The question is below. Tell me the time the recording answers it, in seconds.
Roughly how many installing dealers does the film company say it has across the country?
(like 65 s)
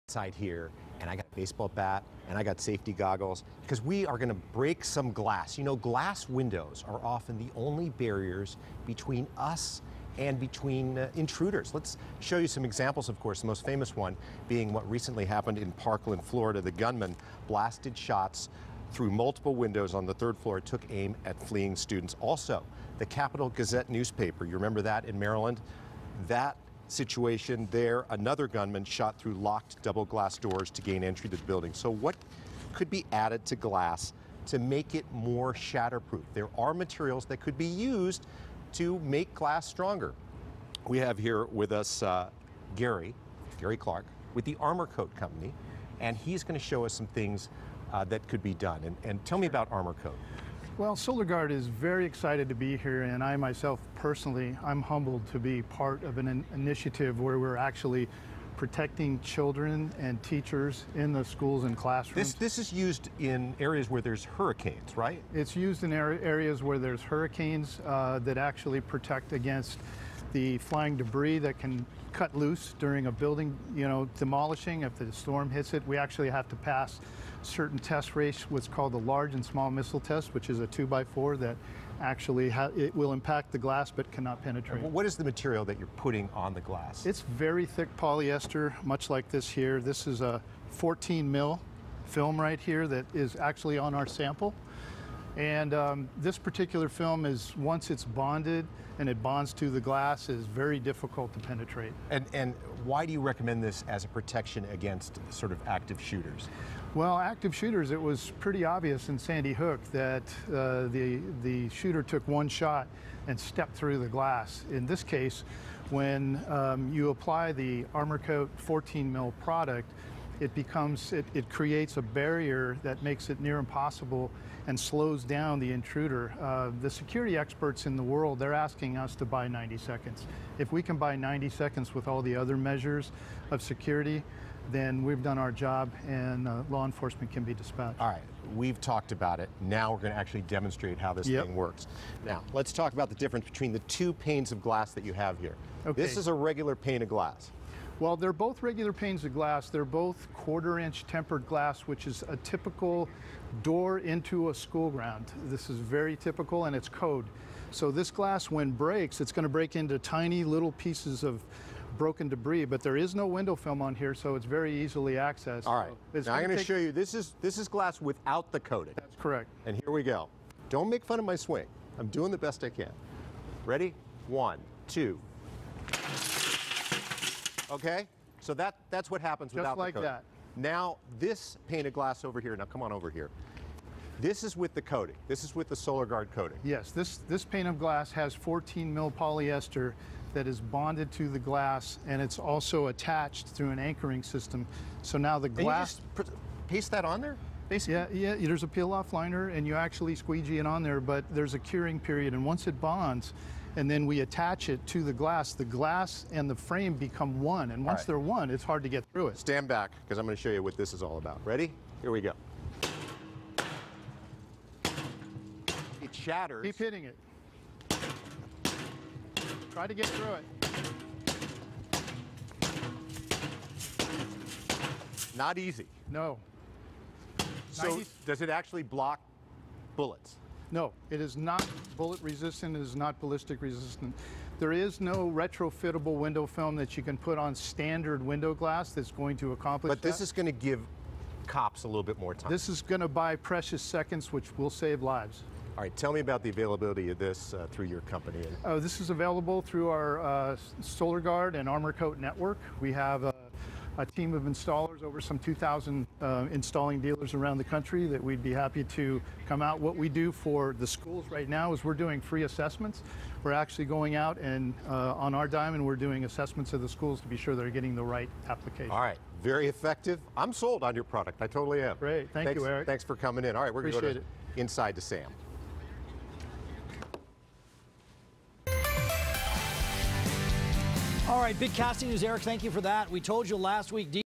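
255 s.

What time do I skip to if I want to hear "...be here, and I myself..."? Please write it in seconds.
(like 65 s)
52 s.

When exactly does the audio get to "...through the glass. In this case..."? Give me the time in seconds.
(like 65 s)
113 s.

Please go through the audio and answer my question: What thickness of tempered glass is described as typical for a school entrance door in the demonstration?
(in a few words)
quarter inch.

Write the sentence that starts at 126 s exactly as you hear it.
Uh, the security experts in the world, they're asking us to buy 90 seconds.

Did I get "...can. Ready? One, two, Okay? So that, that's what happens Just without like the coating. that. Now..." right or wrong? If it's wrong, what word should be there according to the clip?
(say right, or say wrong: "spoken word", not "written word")
right.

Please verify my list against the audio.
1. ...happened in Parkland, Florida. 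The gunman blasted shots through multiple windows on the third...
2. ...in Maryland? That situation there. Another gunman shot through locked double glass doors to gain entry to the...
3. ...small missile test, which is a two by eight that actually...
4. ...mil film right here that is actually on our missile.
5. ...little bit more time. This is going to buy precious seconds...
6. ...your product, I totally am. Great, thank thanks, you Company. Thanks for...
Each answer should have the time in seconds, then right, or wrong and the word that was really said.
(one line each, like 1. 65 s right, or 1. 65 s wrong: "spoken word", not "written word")
1. 15 s right
2. 25 s right
3. 79 s wrong: "four", not "eight"
4. 91 s wrong: "sample", not "missile"
5. 241 s right
6. 270 s wrong: "Eric", not "Company".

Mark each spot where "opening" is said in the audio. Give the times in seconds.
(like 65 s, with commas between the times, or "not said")
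not said.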